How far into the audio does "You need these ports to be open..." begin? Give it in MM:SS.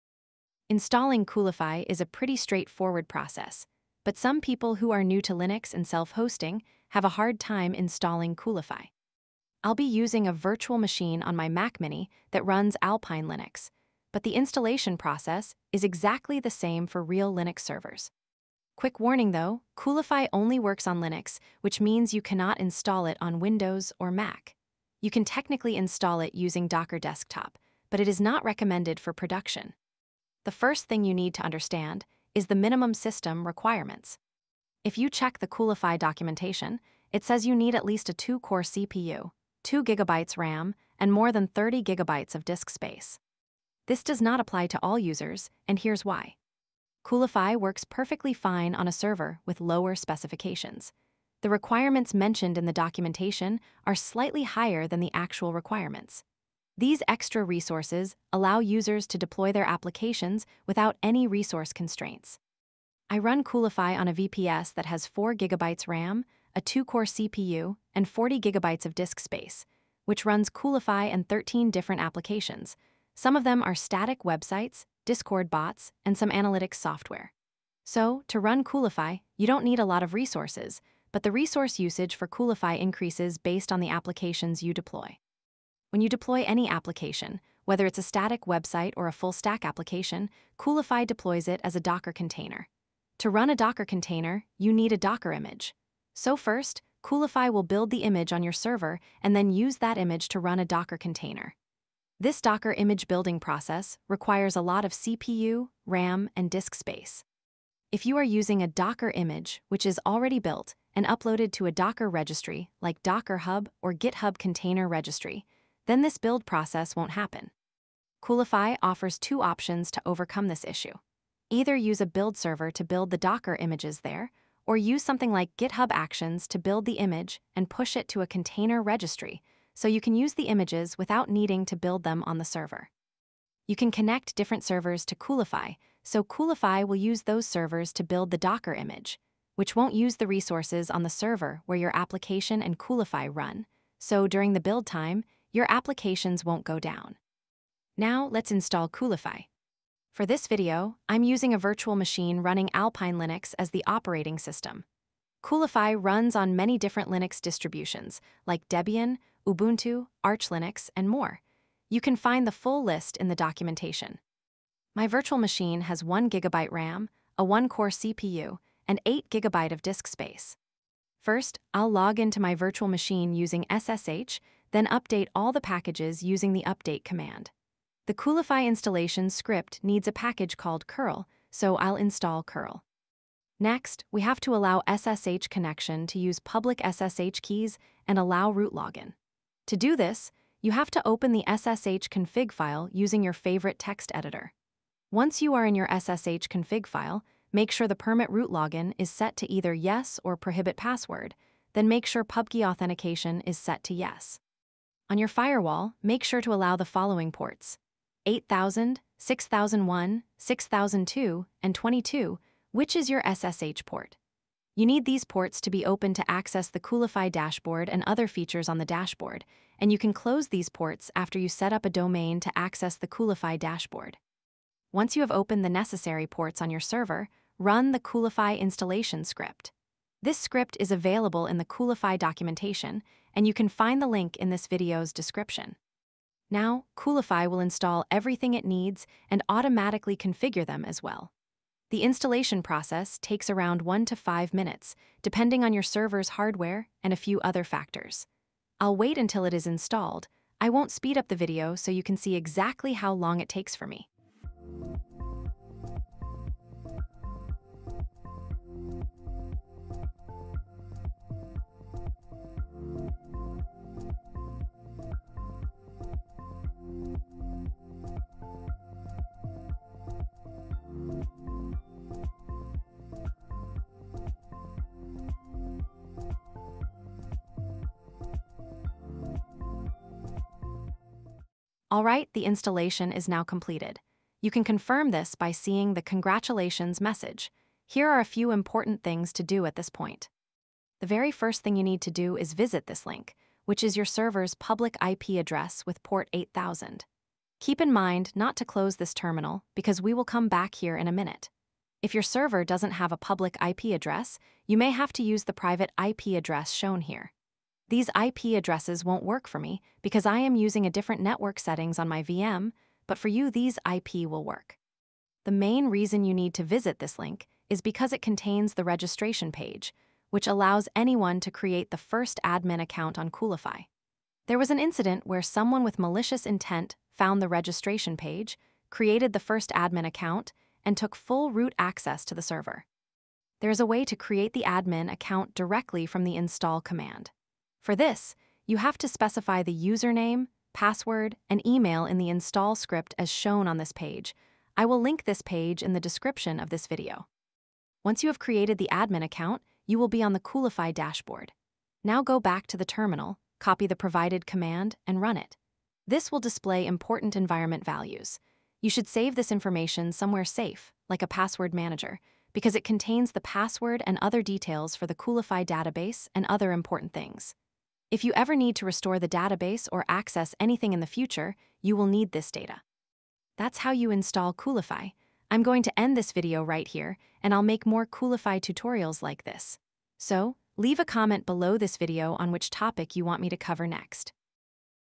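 03:34.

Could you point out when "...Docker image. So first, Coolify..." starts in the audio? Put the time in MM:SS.
01:34.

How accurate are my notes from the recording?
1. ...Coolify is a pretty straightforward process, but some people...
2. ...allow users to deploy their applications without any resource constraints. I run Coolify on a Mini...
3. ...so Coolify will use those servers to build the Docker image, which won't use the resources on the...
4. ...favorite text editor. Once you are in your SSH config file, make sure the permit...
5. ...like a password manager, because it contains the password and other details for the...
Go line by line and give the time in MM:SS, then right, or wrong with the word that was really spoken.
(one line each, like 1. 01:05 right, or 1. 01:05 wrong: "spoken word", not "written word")
1. 00:01 right
2. 00:58 wrong: "VPS", not "Mini"
3. 02:16 right
4. 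03:13 right
5. 06:01 right.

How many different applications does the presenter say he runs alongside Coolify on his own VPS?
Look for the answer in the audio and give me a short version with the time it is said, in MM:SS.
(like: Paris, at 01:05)
13, at 01:11.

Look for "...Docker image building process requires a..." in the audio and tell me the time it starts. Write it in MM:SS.
01:42.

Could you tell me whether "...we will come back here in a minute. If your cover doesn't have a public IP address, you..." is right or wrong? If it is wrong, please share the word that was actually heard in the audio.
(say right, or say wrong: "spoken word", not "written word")
wrong: "server", not "cover".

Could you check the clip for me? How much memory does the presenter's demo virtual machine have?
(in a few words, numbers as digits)
1GB.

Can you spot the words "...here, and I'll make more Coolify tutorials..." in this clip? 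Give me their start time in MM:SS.
06:16.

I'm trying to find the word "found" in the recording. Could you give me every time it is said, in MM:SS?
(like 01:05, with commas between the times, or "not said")
05:27.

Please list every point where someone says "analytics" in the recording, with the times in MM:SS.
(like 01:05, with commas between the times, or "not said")
01:16.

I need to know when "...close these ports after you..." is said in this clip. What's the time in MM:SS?
03:40.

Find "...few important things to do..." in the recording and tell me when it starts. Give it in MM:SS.
04:48.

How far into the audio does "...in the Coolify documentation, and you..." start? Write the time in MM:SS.
03:51.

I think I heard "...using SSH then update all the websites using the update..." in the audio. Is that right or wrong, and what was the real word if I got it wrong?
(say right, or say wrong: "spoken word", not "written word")
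wrong: "packages", not "websites".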